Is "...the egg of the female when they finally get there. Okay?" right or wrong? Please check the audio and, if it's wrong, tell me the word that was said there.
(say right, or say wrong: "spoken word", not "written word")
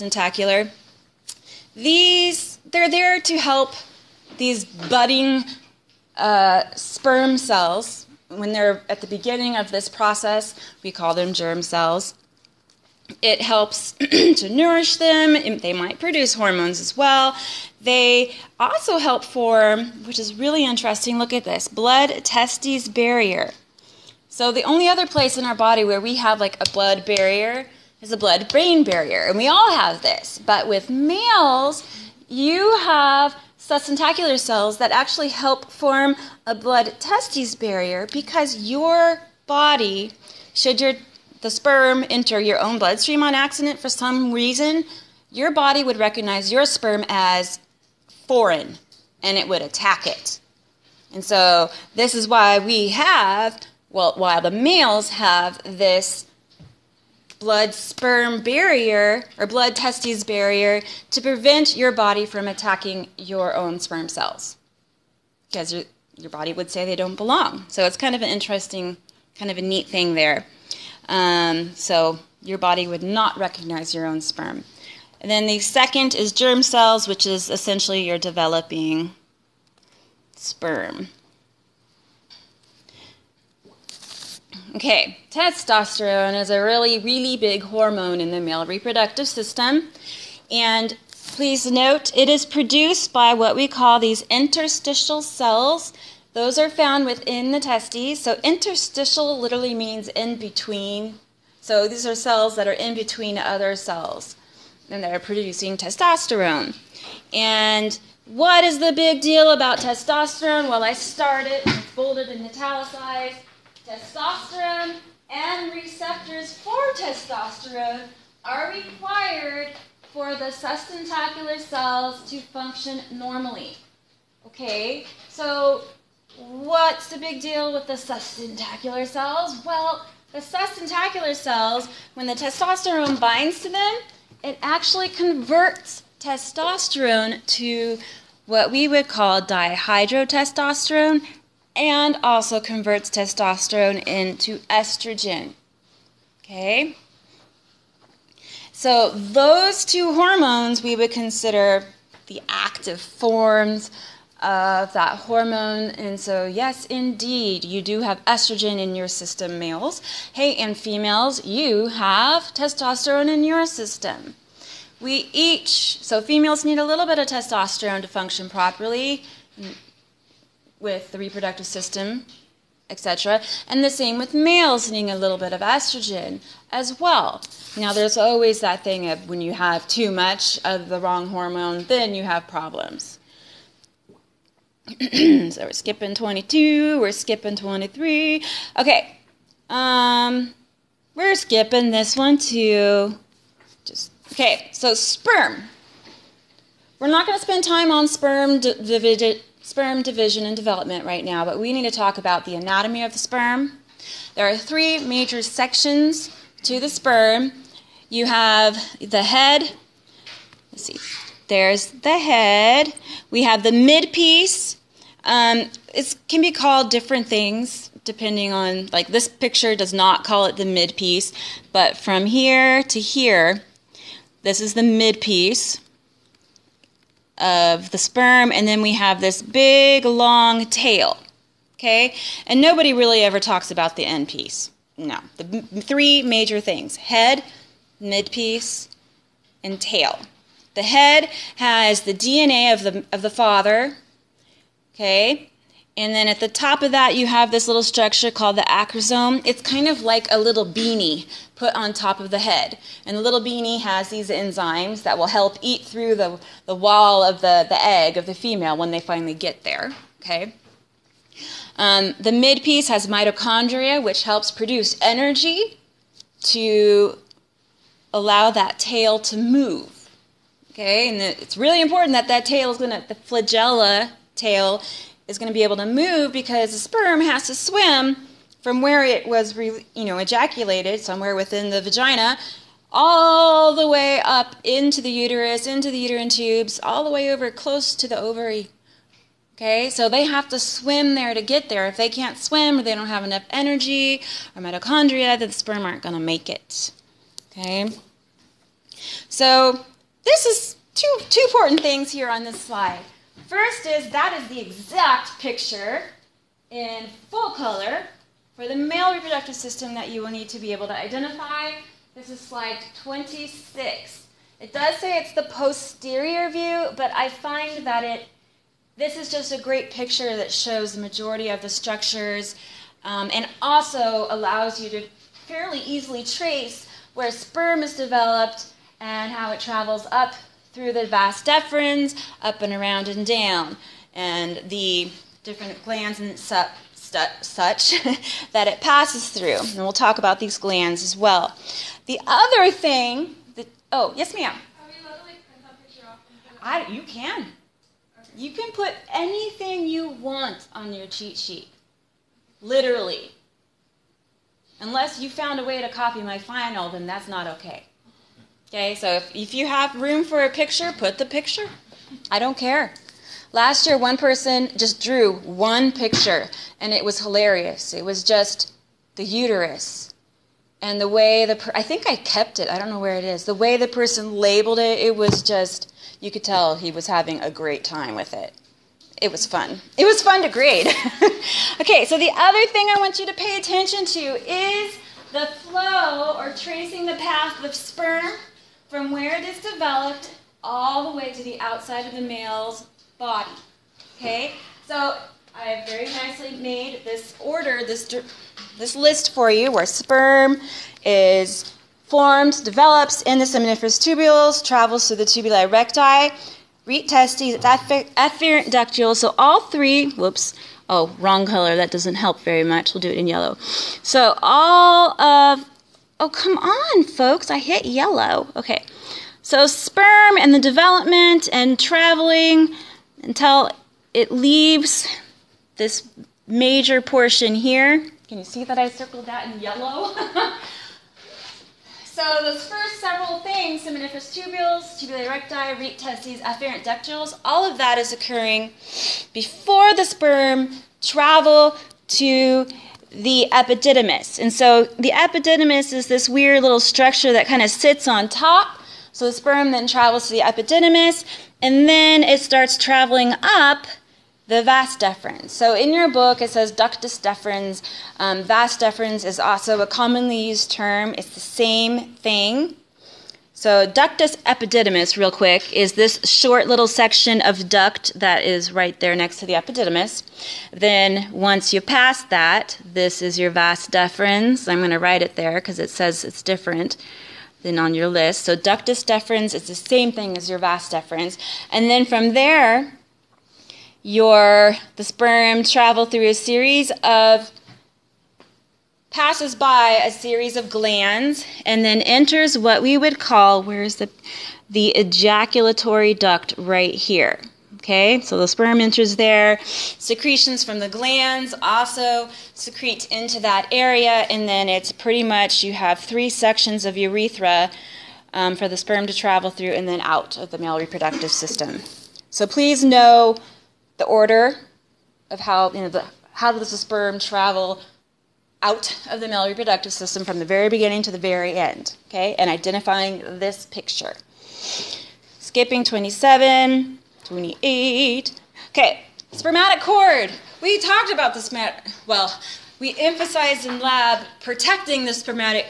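right.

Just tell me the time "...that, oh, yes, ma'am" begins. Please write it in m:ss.
5:43.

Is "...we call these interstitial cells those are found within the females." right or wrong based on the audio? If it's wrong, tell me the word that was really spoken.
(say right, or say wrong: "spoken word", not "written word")
wrong: "testes", not "females".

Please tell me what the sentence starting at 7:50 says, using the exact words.
Then, once you pass that, this is your vas deferens.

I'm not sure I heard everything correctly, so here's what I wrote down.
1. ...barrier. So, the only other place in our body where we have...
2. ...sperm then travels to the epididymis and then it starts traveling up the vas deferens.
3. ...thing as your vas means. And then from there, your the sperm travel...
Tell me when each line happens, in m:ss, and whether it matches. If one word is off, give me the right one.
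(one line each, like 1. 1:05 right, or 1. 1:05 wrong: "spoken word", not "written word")
1. 0:22 right
2. 7:29 right
3. 8:00 wrong: "deferens", not "means".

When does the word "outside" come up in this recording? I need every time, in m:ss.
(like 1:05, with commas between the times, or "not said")
6:31.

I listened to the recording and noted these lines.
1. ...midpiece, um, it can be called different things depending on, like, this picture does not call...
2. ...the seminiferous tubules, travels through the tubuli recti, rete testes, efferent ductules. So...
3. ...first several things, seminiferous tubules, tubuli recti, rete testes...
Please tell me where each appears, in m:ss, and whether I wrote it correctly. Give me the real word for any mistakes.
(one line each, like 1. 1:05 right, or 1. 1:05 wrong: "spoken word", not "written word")
1. 3:33 right
2. 6:43 right
3. 7:12 right.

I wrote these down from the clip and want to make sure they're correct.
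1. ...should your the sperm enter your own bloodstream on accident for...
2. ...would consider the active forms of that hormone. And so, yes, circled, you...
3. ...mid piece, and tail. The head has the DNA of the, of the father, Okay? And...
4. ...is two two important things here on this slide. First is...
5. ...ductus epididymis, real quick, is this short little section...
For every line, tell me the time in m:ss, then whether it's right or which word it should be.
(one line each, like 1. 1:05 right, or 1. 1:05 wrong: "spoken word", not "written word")
1. 0:40 right
2. 2:30 wrong: "indeed", not "circled"
3. 3:57 right
4. 5:00 right
5. 7:43 right.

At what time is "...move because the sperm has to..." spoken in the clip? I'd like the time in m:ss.
4:35.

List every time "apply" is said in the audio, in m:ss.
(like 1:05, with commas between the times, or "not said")
not said.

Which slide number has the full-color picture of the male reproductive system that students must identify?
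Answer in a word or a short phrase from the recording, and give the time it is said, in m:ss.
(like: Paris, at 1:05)
26, at 5:13.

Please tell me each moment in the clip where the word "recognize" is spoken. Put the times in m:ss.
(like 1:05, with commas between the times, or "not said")
0:45, 1:13.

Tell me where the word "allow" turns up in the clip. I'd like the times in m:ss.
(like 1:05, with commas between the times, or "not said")
4:28, 5:24.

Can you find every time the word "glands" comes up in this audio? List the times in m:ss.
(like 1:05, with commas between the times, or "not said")
5:35, 5:40, 8:10, 8:20.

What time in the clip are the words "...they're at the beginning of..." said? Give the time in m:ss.
0:08.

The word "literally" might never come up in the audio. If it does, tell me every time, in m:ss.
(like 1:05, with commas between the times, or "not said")
1:39, 5:52.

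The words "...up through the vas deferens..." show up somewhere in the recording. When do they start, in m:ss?
5:30.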